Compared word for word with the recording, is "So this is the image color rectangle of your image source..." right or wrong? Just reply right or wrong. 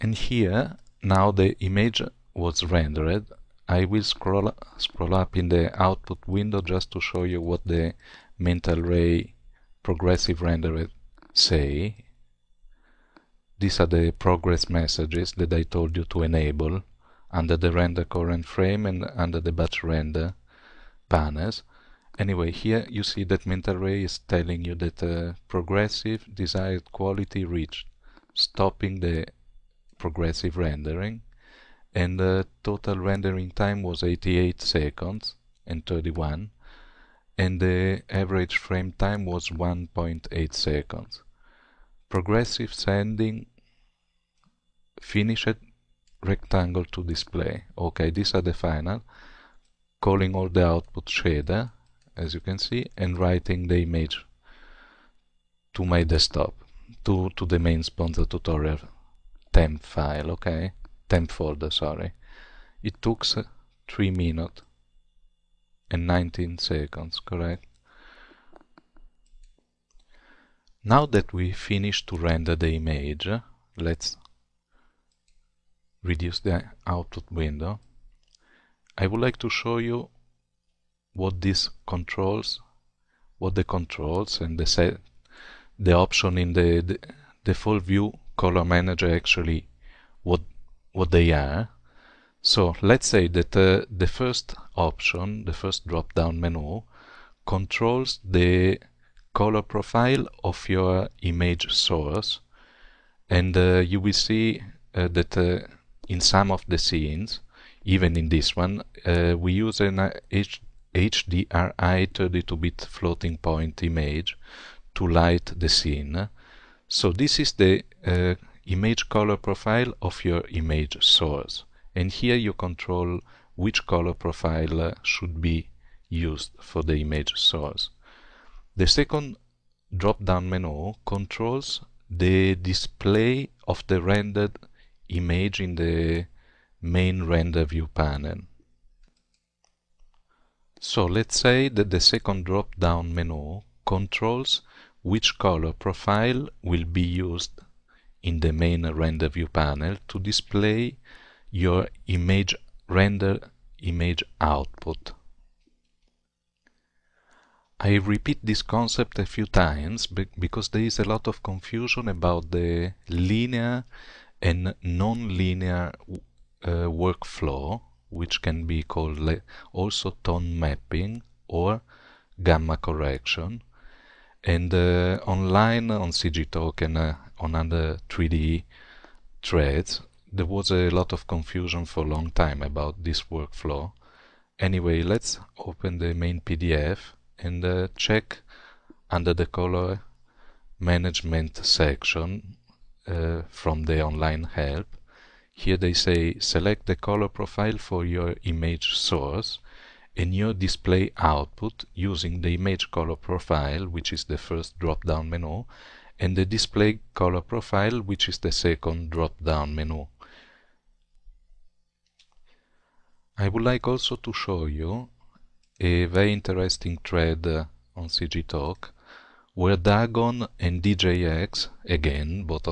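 wrong.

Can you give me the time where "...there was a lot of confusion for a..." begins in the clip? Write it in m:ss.
3:00.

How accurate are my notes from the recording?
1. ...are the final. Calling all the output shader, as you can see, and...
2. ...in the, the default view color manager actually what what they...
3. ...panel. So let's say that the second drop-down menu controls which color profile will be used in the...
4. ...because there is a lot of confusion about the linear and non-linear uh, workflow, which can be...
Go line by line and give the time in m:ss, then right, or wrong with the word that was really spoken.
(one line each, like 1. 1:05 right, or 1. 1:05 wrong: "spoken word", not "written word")
1. 0:48 right
2. 1:26 right
3. 2:17 right
4. 2:40 right.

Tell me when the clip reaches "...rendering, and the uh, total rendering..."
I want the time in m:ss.
0:30.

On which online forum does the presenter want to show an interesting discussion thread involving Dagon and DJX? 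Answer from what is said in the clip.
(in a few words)
CG Talk.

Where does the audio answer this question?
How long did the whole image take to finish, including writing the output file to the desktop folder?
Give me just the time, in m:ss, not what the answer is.
1:03.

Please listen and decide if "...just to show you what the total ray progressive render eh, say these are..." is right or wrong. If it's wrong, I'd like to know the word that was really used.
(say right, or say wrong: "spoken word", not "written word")
wrong: "mental", not "total".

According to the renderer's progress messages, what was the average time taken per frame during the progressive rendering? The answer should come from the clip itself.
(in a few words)
1.8 seconds.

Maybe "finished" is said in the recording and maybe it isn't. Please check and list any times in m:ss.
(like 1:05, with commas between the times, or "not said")
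0:44, 1:11.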